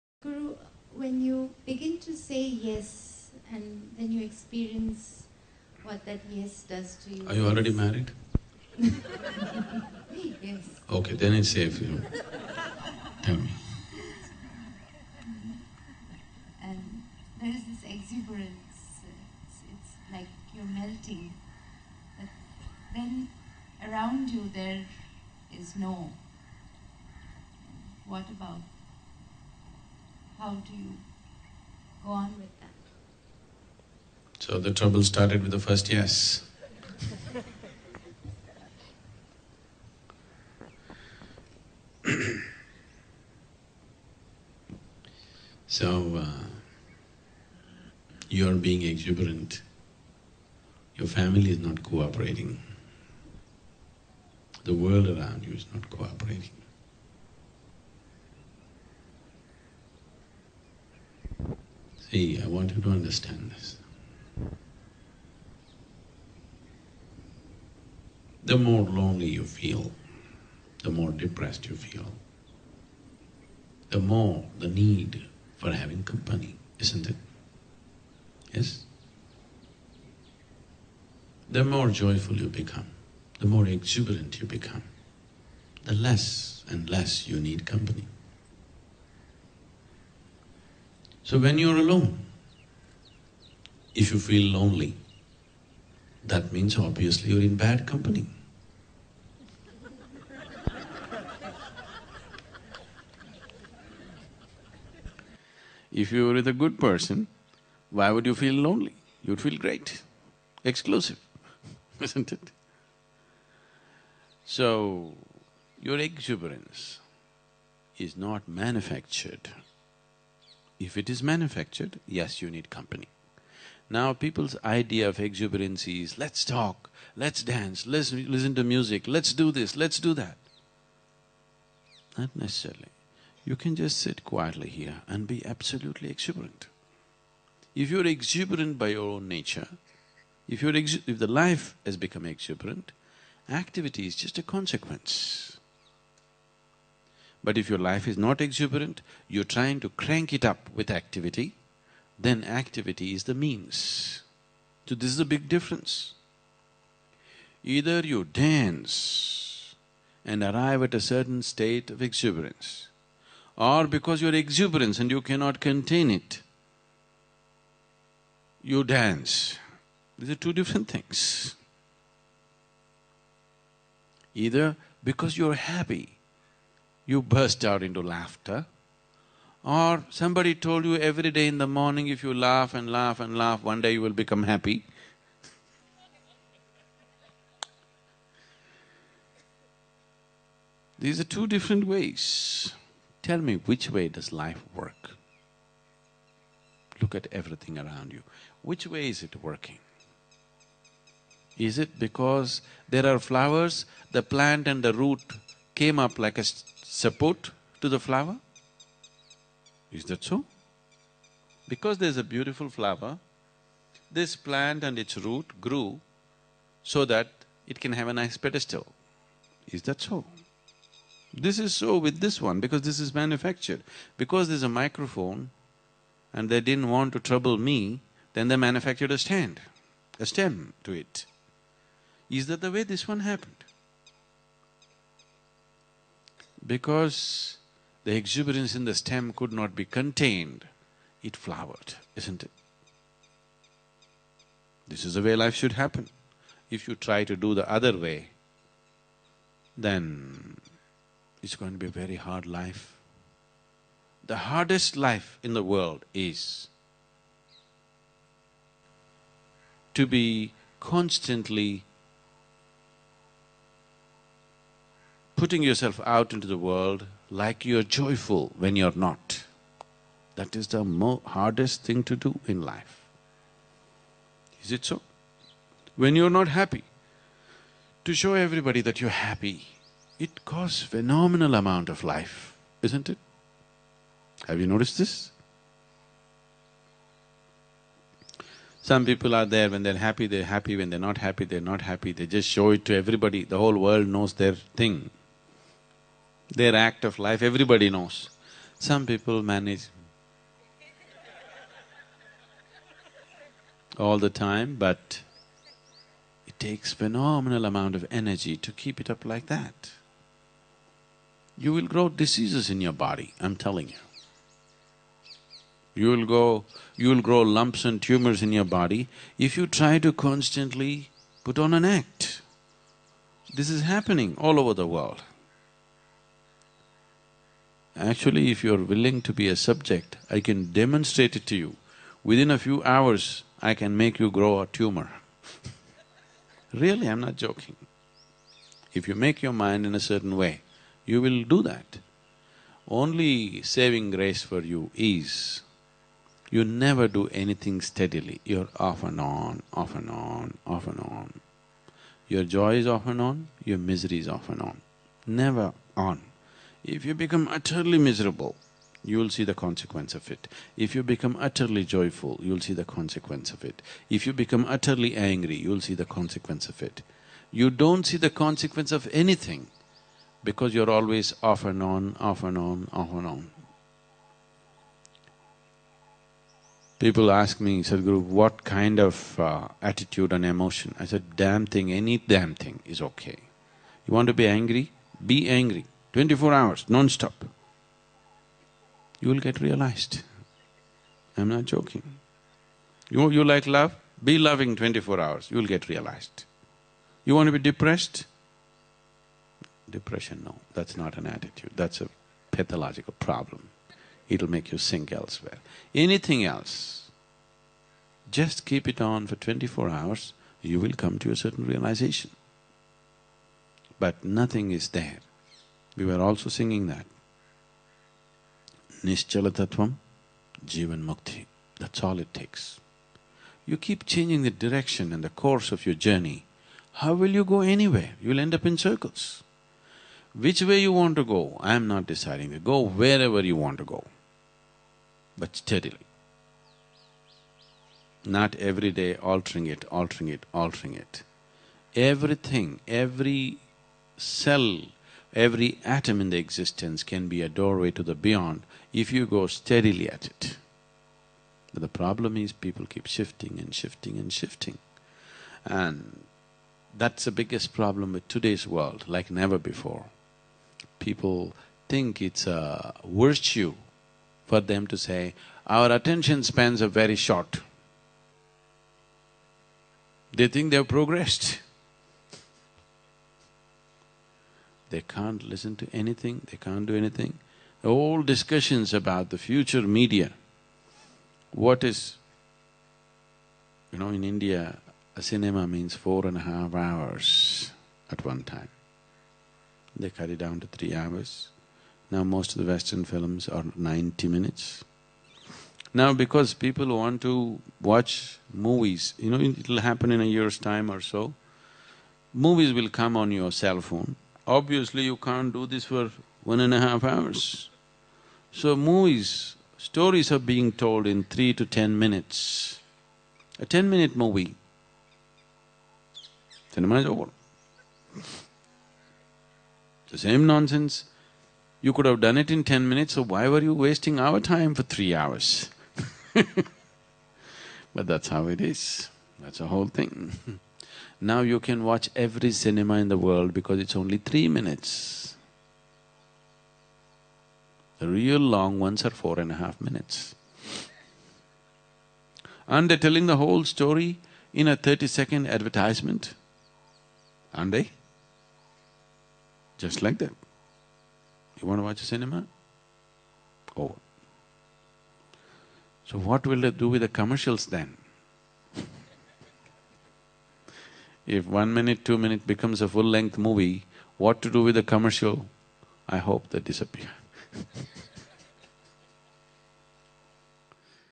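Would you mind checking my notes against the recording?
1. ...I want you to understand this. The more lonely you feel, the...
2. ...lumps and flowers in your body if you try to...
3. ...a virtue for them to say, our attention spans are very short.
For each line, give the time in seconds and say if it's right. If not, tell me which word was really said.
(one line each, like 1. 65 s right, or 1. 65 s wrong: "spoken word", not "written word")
1. 62 s right
2. 317 s wrong: "tumors", not "flowers"
3. 462 s right.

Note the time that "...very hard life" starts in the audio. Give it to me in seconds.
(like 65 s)
251 s.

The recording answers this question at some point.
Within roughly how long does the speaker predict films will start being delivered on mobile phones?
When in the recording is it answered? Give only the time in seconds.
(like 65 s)
500 s.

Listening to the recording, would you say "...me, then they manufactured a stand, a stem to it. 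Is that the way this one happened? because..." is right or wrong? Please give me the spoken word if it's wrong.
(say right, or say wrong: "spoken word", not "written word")
right.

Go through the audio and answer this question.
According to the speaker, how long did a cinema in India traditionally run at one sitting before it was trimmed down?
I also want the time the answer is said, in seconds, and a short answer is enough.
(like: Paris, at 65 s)
4.5 hours, at 485 s.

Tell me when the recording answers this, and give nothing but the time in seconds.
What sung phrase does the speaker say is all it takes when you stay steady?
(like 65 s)
419 s.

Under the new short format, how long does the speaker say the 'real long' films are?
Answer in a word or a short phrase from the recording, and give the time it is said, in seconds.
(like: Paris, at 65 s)
4.5 minutes, at 539 s.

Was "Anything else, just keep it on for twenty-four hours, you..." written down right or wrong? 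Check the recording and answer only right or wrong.
right.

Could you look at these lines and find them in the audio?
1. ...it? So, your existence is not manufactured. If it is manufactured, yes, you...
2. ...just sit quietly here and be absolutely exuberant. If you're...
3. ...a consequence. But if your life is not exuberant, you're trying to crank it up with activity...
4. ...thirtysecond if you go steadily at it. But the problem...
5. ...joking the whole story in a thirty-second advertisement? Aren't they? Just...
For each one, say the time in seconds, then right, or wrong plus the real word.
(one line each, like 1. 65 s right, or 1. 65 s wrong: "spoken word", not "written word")
1. 112 s wrong: "exuberance", not "existence"
2. 133 s right
3. 144 s right
4. 448 s wrong: "beyond", not "thirtysecond"
5. 542 s wrong: "telling", not "joking".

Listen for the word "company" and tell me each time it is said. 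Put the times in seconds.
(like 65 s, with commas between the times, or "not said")
76 s, 87 s, 97 s, 122 s.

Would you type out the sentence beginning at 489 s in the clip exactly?
They cut it down to three hours.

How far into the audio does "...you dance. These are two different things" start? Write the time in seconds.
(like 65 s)
168 s.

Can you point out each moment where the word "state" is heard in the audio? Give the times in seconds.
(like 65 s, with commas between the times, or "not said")
161 s.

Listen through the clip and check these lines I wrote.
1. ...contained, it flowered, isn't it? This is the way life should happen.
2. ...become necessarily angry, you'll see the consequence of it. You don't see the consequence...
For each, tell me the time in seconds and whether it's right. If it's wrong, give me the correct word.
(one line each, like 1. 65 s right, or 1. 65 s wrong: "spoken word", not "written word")
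1. 239 s right
2. 364 s wrong: "utterly", not "necessarily".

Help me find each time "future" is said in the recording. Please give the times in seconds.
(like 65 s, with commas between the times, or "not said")
479 s.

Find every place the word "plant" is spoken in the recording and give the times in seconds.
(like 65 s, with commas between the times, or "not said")
204 s, 214 s.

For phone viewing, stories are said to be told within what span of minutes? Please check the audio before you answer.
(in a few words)
3 to 10 minutes.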